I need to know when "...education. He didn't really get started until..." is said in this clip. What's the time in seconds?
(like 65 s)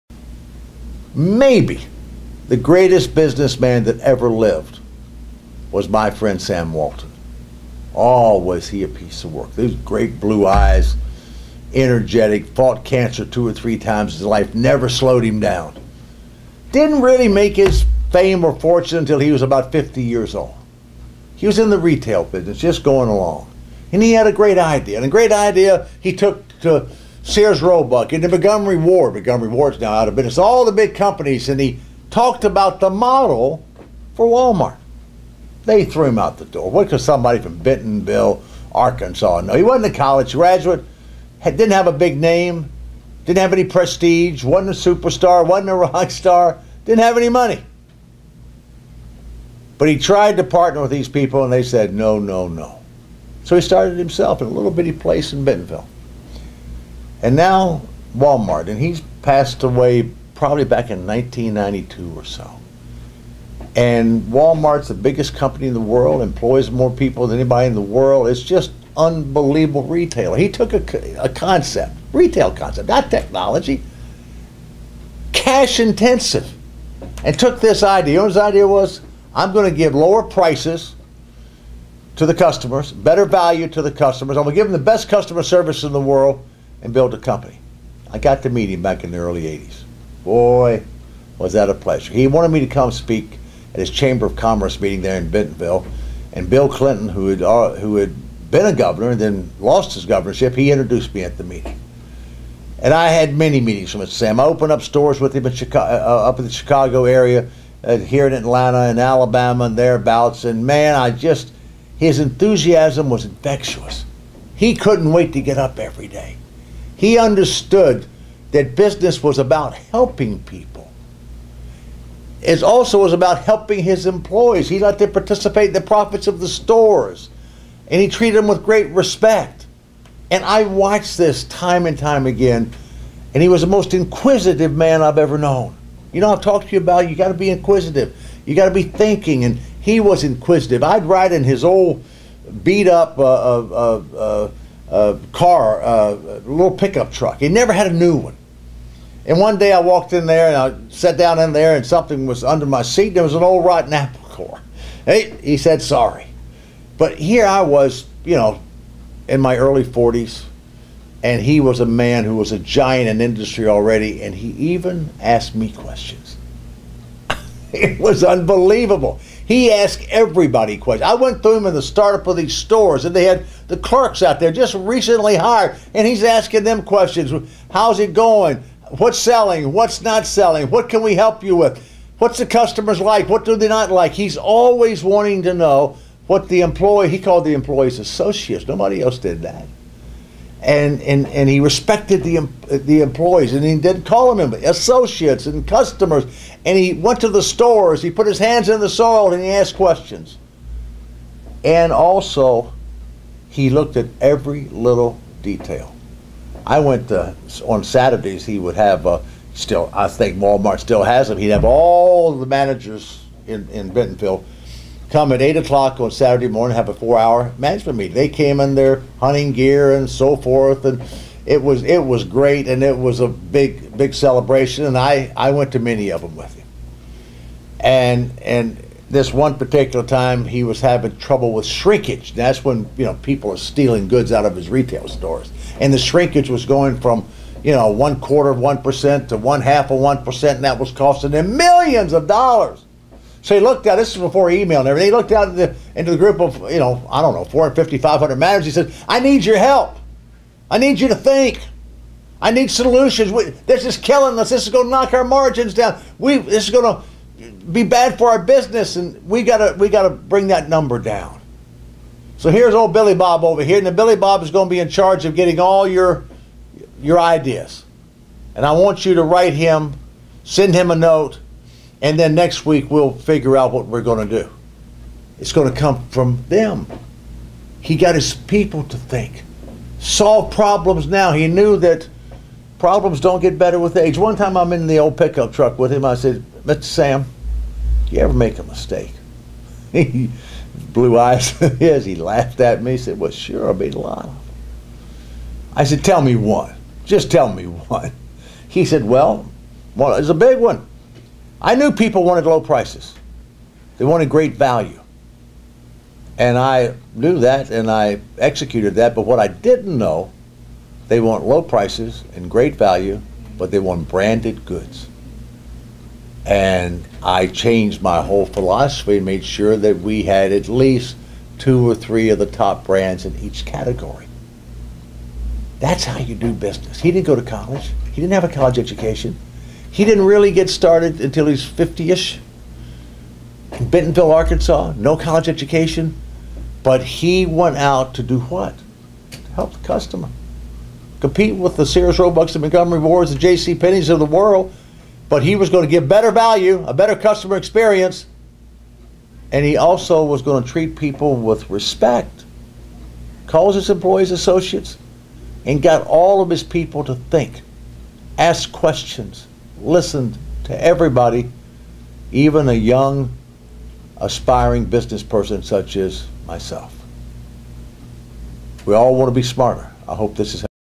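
328 s.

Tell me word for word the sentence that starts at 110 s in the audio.
And man, I just, his enthusiasm was infectious.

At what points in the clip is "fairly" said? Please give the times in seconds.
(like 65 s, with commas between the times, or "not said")
not said.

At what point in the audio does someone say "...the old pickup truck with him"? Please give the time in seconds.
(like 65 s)
284 s.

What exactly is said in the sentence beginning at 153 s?
There was an old rotten apple core.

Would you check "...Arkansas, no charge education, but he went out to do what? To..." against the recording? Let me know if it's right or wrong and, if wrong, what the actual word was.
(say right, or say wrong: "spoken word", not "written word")
wrong: "college", not "charge".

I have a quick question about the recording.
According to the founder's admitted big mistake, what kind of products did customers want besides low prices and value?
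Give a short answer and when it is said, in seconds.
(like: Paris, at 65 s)
Branded goods, at 314 s.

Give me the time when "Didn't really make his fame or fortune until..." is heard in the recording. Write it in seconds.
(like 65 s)
16 s.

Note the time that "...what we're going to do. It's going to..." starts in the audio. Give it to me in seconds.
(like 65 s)
273 s.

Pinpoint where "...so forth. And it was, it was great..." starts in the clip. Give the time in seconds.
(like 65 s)
220 s.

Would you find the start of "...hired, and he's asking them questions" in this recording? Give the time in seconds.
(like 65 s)
175 s.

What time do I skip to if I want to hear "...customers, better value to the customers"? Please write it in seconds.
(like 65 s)
82 s.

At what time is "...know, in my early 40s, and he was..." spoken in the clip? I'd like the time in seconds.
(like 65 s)
158 s.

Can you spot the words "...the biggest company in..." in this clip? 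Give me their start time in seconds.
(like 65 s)
64 s.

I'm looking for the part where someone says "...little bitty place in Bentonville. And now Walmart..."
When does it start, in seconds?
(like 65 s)
54 s.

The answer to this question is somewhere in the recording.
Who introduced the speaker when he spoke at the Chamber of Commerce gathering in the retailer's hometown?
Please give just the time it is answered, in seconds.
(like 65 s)
96 s.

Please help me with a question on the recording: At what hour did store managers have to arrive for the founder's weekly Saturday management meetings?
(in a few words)
8 o'clock.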